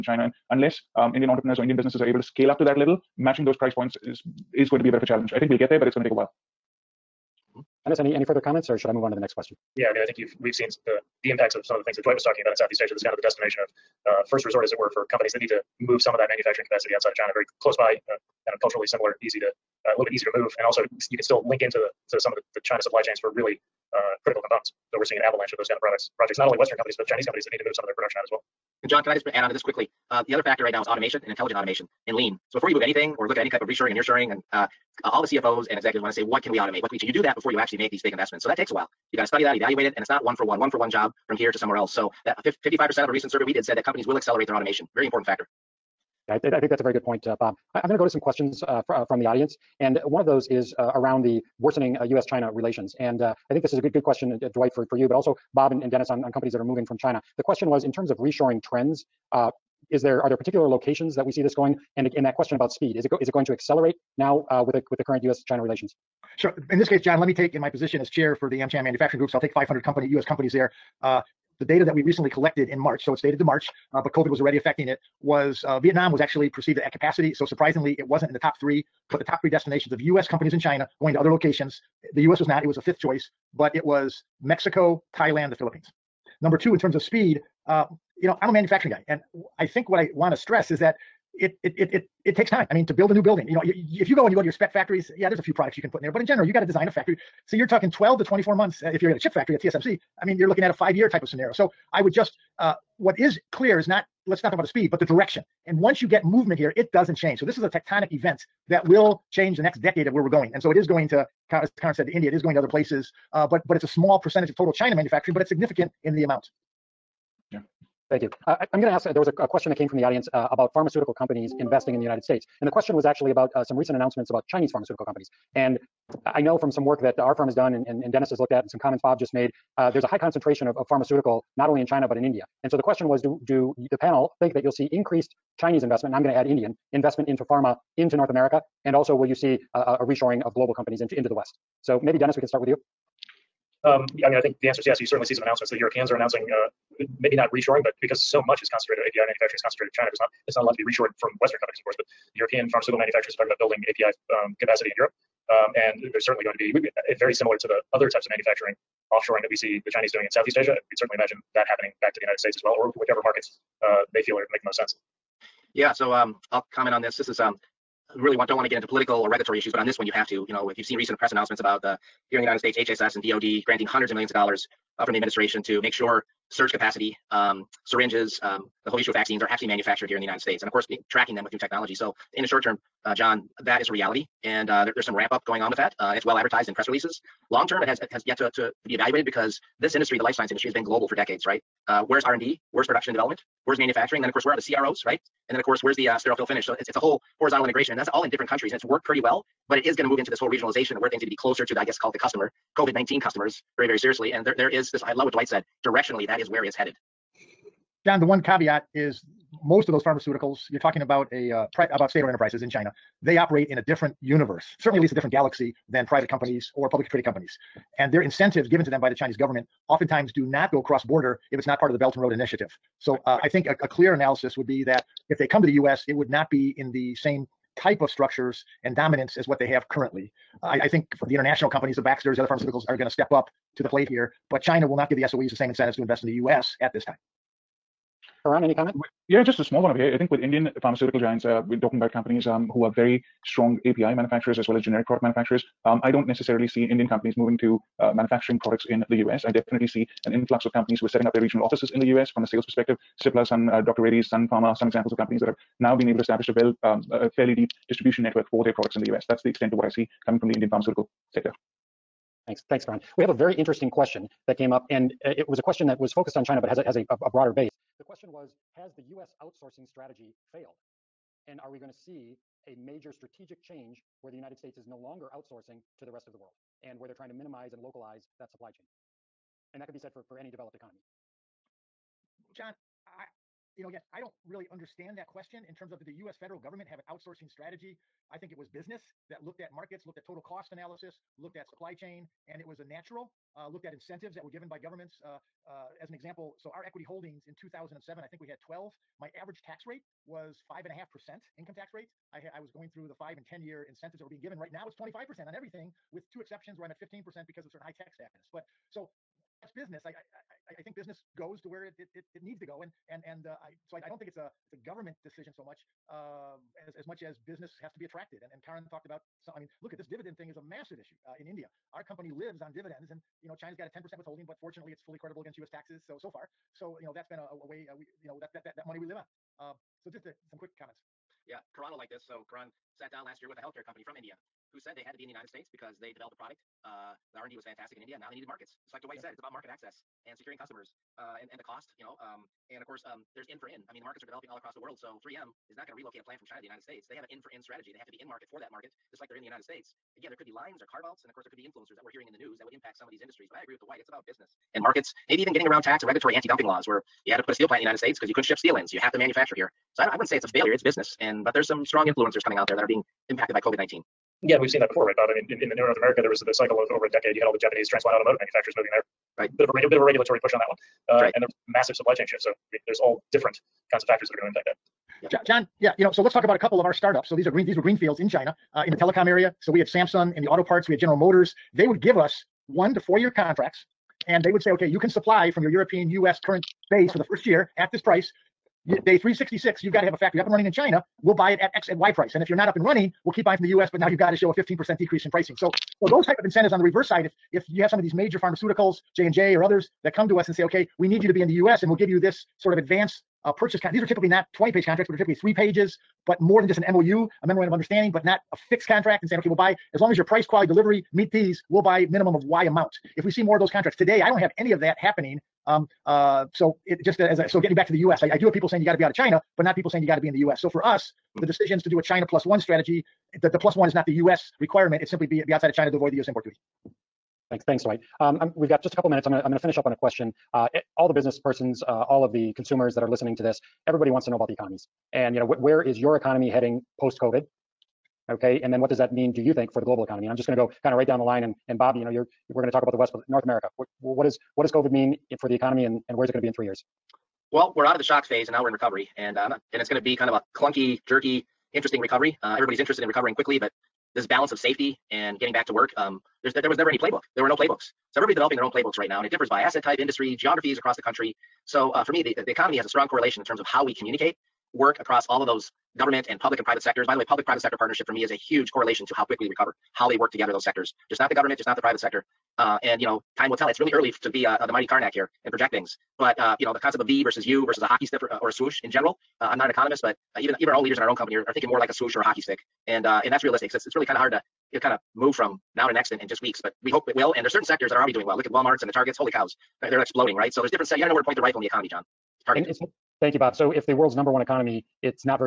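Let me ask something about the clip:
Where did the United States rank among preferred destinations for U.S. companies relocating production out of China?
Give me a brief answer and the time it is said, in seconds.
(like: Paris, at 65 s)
Fifth, at 82 s.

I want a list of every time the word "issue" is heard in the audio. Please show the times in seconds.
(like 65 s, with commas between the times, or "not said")
169 s, 178 s, 320 s.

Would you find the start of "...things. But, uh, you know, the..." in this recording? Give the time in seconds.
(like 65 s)
475 s.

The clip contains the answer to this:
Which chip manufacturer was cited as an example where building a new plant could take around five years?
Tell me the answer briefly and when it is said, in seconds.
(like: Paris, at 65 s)
TSMC, at 99 s.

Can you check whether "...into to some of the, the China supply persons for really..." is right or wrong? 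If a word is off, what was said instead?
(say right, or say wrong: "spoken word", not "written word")
wrong: "chains", not "persons".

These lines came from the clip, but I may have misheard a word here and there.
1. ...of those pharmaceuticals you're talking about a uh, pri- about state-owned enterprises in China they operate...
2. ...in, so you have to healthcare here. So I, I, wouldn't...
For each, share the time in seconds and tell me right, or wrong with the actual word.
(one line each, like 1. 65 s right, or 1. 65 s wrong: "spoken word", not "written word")
1. 209 s right
2. 358 s wrong: "manufacture", not "healthcare".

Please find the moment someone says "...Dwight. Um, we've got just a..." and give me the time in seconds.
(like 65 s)
427 s.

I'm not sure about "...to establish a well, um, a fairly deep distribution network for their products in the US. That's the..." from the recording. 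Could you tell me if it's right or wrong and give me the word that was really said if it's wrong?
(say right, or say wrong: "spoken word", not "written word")
right.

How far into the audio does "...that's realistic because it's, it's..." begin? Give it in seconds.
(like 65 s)
483 s.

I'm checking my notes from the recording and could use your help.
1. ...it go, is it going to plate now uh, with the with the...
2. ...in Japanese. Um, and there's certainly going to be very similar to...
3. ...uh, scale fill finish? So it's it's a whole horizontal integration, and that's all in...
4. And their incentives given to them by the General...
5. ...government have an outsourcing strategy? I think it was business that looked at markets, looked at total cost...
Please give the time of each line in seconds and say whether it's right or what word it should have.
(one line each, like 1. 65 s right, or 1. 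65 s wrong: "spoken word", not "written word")
1. 63 s wrong: "accelerate", not "plate"
2. 154 s wrong: "Europe", not "Japanese"
3. 196 s wrong: "sterile", not "scale"
4. 217 s wrong: "Chinese", not "General"
5. 286 s right.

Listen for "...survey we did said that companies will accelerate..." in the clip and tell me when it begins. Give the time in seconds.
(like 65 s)
43 s.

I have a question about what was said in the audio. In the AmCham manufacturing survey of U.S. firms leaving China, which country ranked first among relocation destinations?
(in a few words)
Mexico.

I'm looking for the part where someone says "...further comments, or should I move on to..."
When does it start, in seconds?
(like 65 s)
8 s.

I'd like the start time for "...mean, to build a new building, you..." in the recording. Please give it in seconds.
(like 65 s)
92 s.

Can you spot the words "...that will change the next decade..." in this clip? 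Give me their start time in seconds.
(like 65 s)
108 s.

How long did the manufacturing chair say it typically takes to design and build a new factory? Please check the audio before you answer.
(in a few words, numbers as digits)
12 to 24 months.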